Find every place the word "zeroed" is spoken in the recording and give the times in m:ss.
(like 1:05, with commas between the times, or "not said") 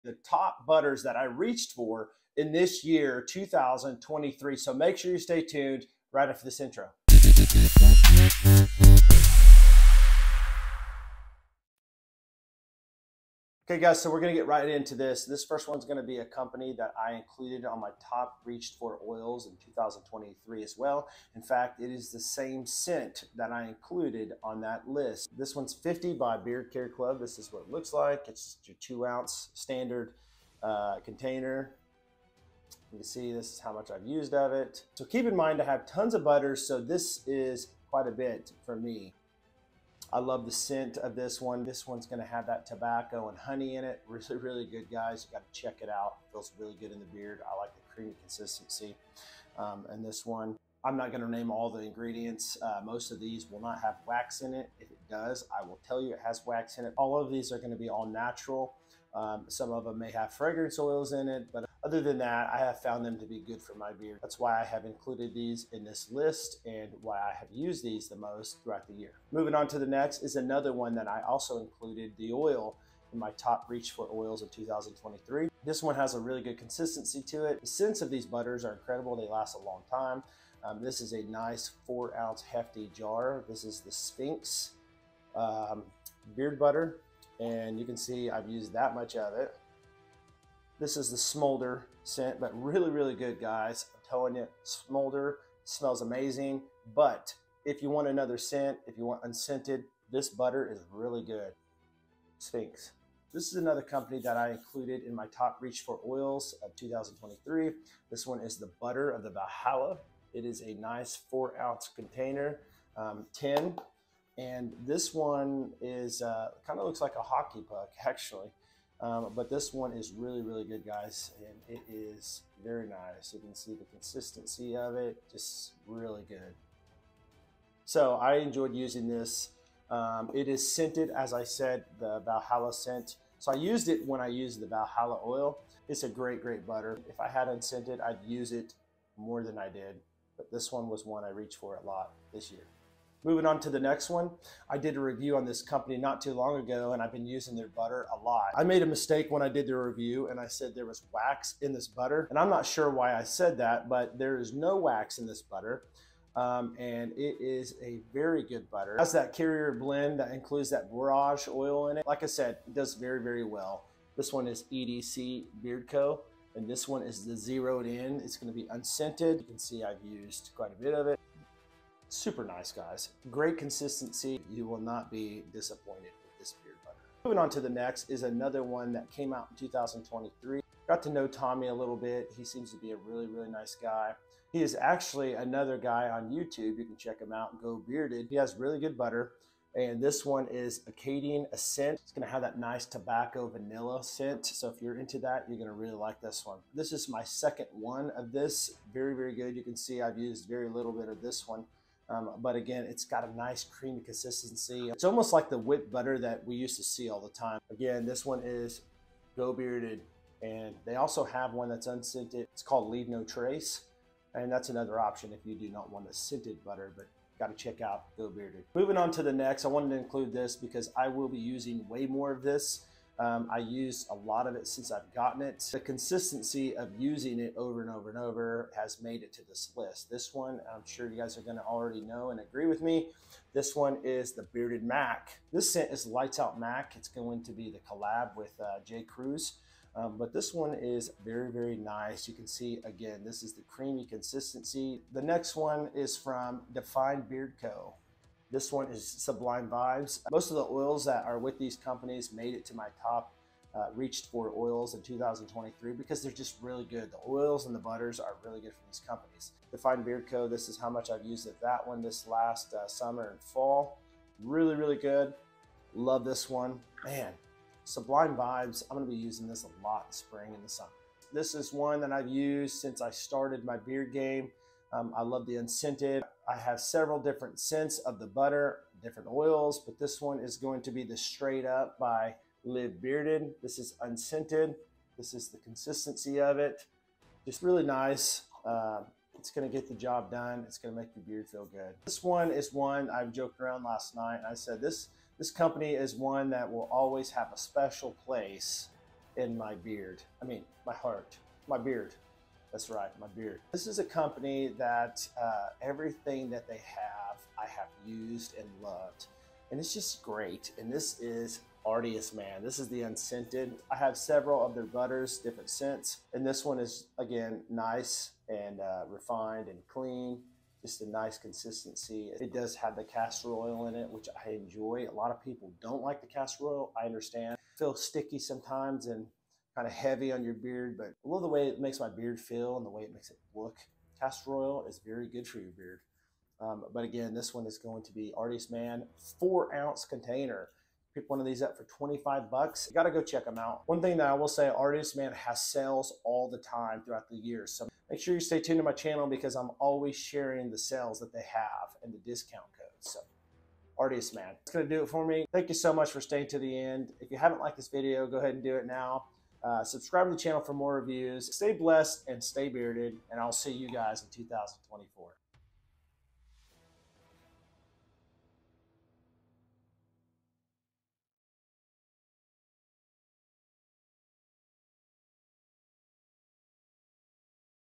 2:47.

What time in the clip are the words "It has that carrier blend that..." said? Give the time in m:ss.
2:38.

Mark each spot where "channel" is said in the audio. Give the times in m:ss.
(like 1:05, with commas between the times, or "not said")
5:48, 6:00.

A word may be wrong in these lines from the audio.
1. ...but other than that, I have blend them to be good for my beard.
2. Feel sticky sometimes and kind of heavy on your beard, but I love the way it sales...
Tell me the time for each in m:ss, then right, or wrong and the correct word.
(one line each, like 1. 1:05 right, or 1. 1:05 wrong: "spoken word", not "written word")
1. 1:01 wrong: "found", not "blend"
2. 5:27 wrong: "makes", not "sales".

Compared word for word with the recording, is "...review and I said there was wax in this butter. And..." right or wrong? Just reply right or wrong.
right.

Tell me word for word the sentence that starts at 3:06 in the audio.
You can check him out, Geaux Bearded.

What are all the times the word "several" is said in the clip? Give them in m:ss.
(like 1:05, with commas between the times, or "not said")
4:36, 5:14.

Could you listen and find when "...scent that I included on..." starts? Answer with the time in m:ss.
0:22.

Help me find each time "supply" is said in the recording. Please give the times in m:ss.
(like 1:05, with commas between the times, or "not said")
not said.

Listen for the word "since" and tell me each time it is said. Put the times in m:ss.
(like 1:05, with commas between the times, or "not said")
3:44, 4:32.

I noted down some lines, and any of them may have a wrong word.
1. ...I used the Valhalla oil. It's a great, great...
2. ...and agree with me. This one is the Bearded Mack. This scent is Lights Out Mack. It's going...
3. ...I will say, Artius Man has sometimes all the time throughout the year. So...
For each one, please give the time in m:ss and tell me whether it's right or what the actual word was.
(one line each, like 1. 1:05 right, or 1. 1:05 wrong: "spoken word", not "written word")
1. 2:14 right
2. 3:52 right
3. 5:44 wrong: "sales", not "sometimes".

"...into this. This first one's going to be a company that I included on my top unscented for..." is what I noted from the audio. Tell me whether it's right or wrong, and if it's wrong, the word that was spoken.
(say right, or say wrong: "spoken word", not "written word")
wrong: "reached", not "unscented".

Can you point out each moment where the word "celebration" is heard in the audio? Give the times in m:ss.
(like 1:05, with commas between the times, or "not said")
not said.